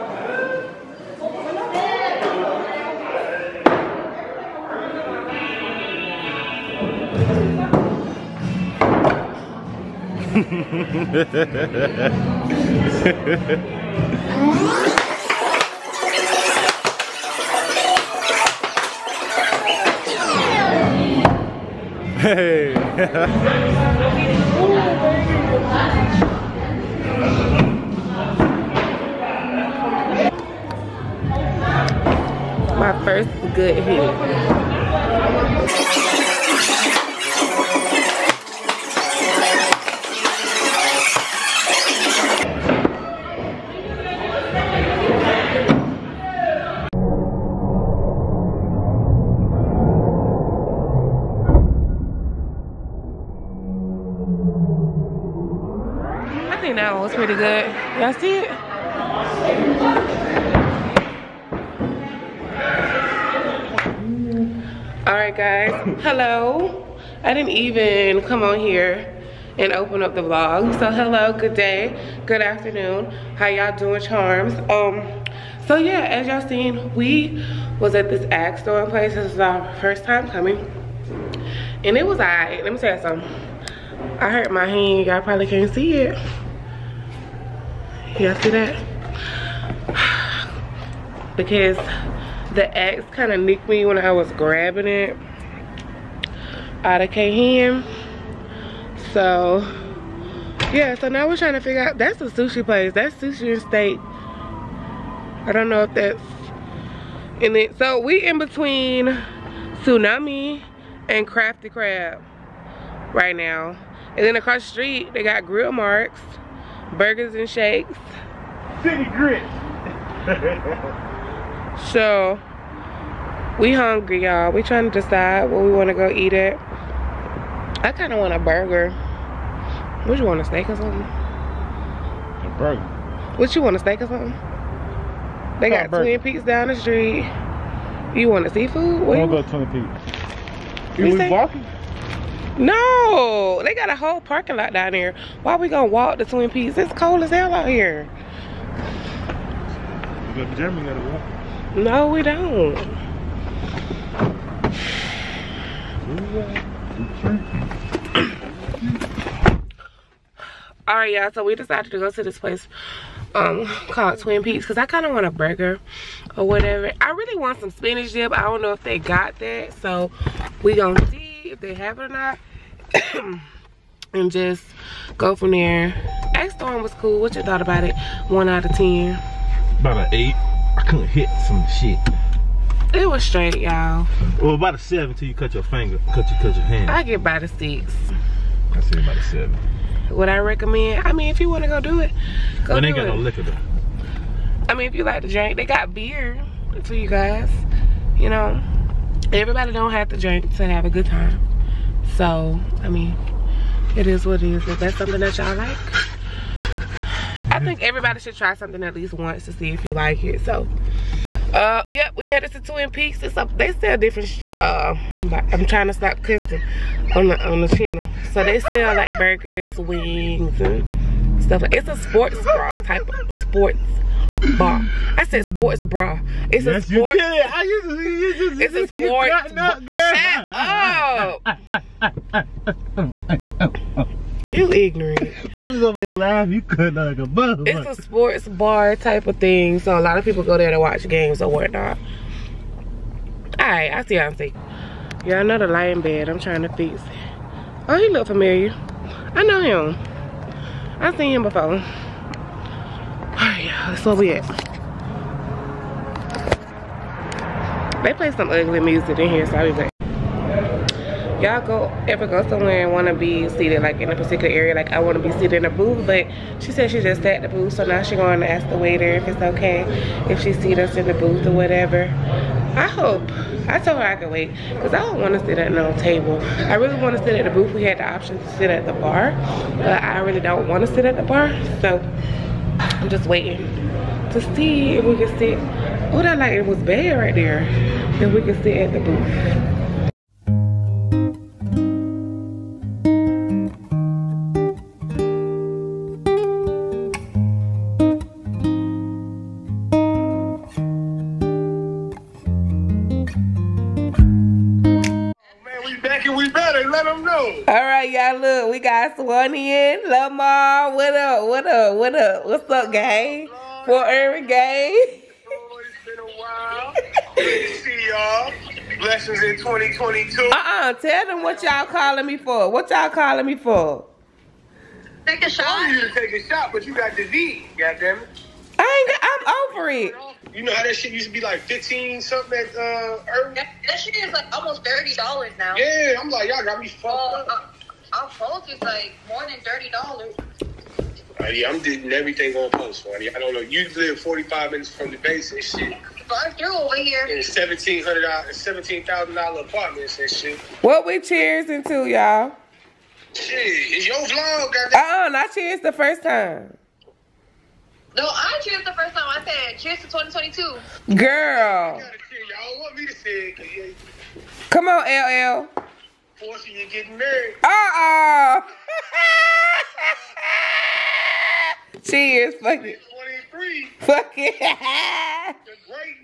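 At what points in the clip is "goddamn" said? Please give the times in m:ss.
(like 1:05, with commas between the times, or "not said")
5:27, 5:54.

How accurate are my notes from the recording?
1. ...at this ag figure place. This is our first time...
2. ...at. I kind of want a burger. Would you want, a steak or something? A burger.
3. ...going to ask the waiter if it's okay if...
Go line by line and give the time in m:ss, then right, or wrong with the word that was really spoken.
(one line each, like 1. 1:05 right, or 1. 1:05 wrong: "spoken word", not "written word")
1. 1:17 wrong: "store", not "figure"
2. 2:06 right
3. 4:28 right.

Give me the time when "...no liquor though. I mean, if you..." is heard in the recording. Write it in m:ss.
3:13.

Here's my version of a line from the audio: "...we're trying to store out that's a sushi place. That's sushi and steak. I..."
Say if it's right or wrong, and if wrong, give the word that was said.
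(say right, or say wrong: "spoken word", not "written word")
wrong: "figure", not "store".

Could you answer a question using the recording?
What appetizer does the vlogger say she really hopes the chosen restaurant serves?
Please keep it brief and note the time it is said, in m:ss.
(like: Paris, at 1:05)
spinach dip, at 2:47.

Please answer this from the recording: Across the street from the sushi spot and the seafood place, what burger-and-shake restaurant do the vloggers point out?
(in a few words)
Grill Marks.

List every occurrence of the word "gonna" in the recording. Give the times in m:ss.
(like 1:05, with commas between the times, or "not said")
2:25, 2:50.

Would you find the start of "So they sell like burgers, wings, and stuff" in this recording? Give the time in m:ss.
3:38.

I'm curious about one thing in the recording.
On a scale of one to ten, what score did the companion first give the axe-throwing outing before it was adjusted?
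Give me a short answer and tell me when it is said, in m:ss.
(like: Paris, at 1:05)
8, at 2:59.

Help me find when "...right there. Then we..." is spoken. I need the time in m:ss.
4:47.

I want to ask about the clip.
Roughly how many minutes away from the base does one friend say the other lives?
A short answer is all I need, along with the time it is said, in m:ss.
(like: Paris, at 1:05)
45, at 5:44.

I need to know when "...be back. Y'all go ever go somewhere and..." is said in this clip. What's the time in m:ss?
4:19.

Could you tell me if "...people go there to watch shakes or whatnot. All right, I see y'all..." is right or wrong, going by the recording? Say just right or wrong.
wrong.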